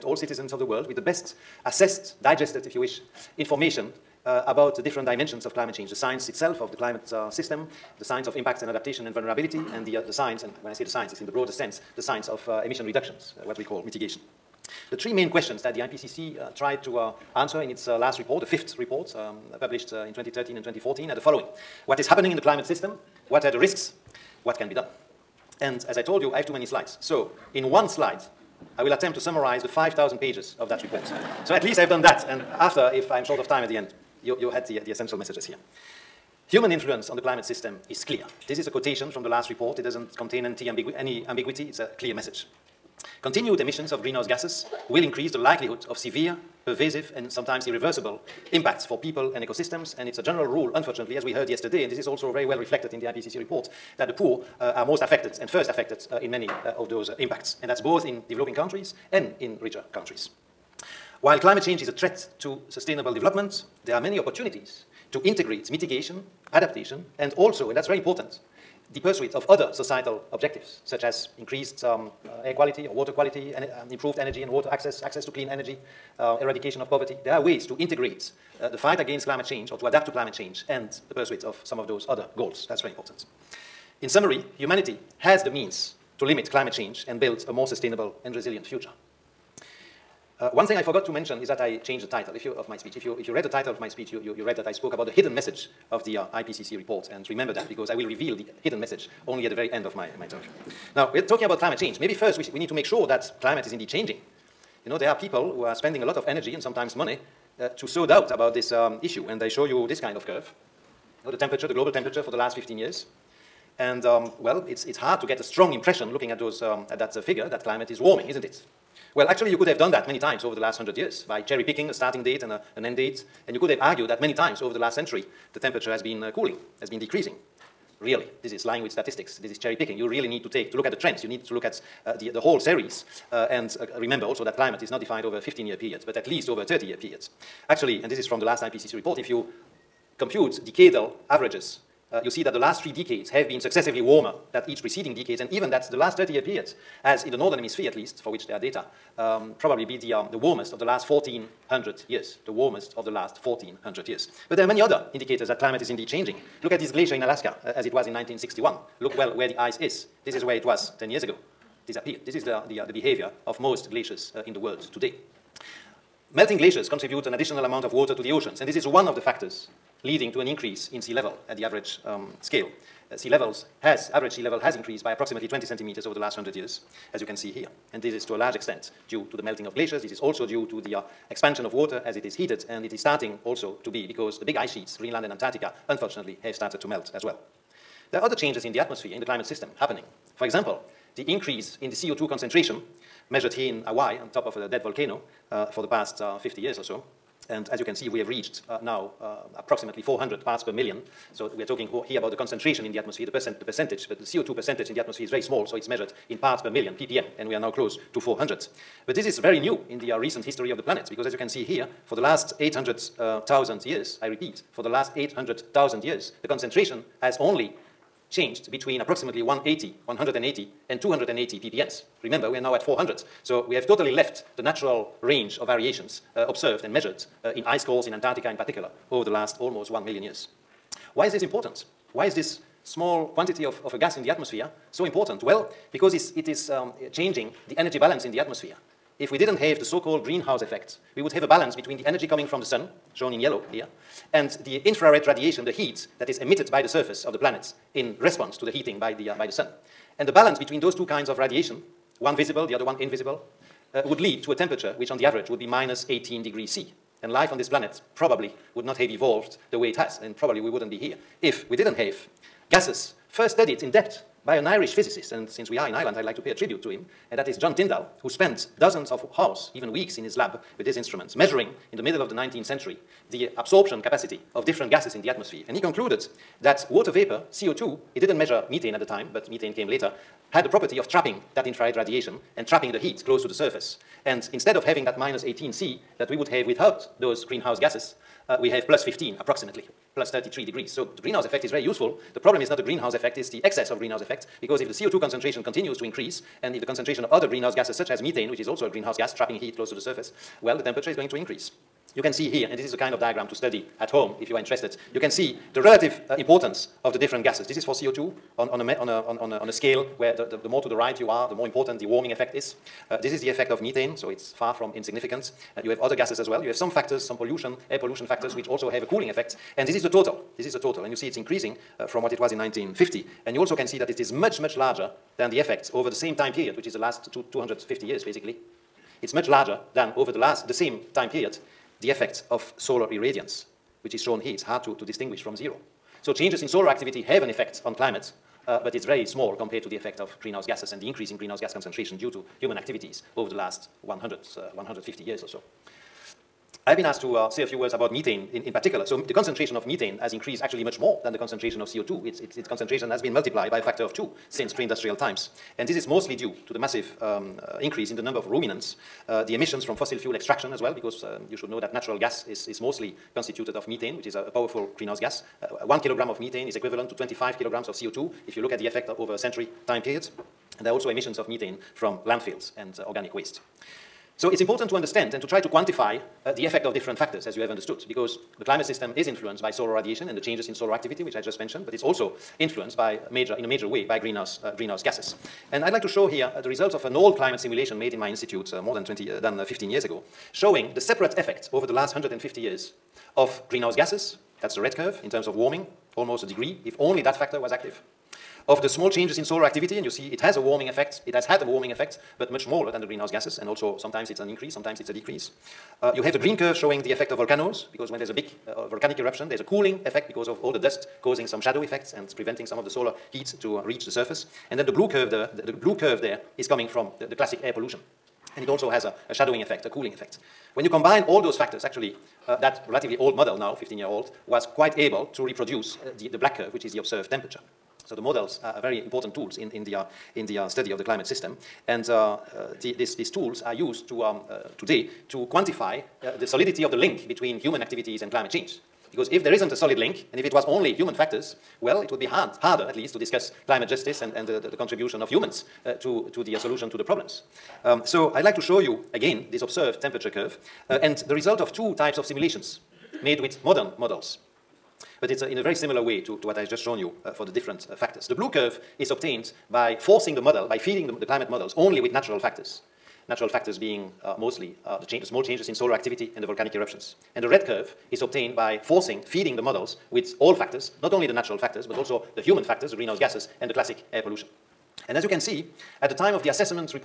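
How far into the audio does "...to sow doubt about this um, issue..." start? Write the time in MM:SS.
01:47.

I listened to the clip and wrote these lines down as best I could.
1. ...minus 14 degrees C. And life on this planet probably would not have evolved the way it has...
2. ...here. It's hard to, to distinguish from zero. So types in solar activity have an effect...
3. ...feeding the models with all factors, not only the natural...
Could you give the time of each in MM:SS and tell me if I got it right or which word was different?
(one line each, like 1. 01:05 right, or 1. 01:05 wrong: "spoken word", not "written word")
1. 04:15 wrong: "18", not "14"
2. 05:34 wrong: "changes", not "types"
3. 07:49 right.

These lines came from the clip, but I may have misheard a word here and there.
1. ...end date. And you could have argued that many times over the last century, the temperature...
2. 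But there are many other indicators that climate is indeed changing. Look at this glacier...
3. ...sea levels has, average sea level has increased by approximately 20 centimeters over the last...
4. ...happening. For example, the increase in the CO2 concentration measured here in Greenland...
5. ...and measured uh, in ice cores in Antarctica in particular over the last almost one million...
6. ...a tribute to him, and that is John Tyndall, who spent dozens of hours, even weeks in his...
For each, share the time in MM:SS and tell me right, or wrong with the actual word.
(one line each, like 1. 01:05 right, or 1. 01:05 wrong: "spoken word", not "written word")
1. 02:02 right
2. 02:34 right
3. 02:53 right
4. 03:09 wrong: "Hawaii", not "Greenland"
5. 03:46 right
6. 04:26 right.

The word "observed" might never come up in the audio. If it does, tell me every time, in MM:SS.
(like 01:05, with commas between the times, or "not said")
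03:46, 07:06, 07:29.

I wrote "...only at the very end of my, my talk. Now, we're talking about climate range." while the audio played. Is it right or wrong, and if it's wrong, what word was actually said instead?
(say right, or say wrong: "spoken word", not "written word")
wrong: "change", not "range".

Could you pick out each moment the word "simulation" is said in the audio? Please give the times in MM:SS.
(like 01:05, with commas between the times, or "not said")
06:27, 07:32.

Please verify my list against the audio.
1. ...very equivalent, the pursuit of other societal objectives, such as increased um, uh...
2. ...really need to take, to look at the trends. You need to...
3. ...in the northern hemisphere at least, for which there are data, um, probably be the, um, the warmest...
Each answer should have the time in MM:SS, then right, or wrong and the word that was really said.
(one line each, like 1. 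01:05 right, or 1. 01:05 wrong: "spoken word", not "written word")
1. 01:07 wrong: "important", not "equivalent"
2. 02:10 right
3. 02:27 right.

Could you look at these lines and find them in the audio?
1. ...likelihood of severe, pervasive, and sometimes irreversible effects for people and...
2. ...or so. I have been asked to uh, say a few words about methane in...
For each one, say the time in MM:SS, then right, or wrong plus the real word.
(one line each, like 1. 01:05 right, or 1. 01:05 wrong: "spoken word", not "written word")
1. 00:45 wrong: "impacts", not "effects"
2. 05:45 right.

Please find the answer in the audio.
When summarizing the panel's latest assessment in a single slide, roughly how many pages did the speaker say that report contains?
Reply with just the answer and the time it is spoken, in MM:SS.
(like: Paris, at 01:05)
5,000, at 00:29.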